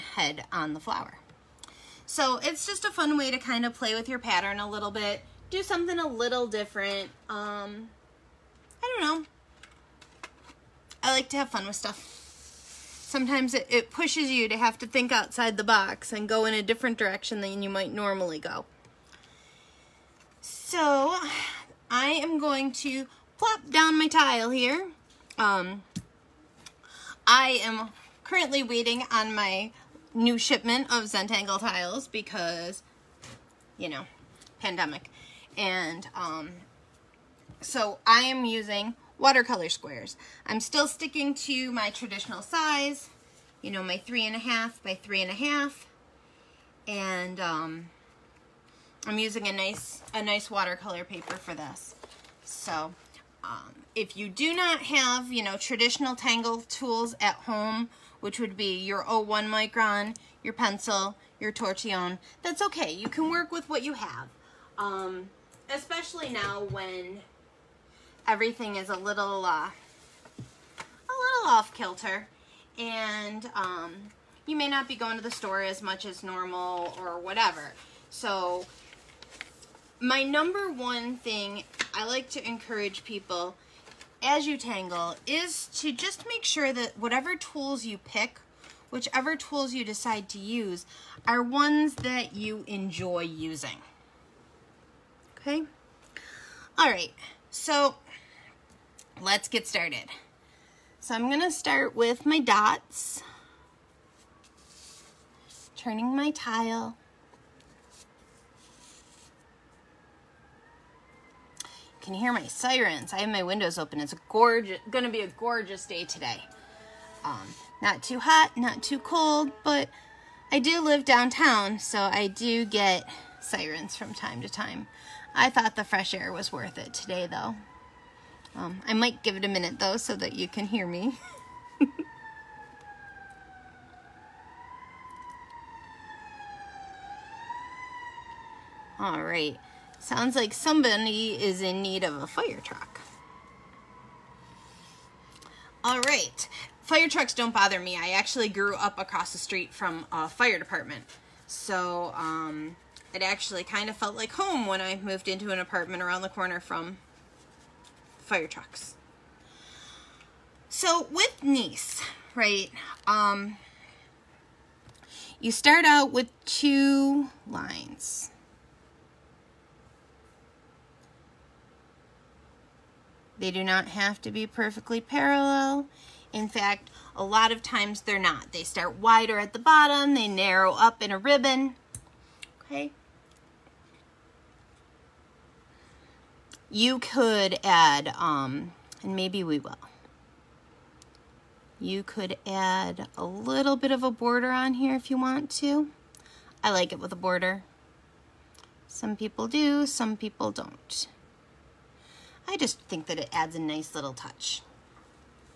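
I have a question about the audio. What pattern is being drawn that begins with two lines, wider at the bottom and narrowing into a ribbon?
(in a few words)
Knase.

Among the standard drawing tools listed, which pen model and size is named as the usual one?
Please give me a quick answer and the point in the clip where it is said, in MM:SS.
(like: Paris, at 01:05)
01 micron, at 00:59.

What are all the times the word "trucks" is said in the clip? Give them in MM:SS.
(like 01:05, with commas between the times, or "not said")
02:22, 02:27, 02:38.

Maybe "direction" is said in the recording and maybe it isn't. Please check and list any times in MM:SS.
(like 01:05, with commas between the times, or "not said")
00:16.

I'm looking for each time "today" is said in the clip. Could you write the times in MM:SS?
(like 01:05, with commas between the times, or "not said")
01:56, 02:06.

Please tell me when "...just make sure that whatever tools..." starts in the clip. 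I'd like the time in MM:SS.
01:25.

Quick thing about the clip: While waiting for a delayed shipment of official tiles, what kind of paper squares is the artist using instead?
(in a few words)
watercolor squares.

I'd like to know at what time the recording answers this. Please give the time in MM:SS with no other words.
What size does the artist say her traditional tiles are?
00:43.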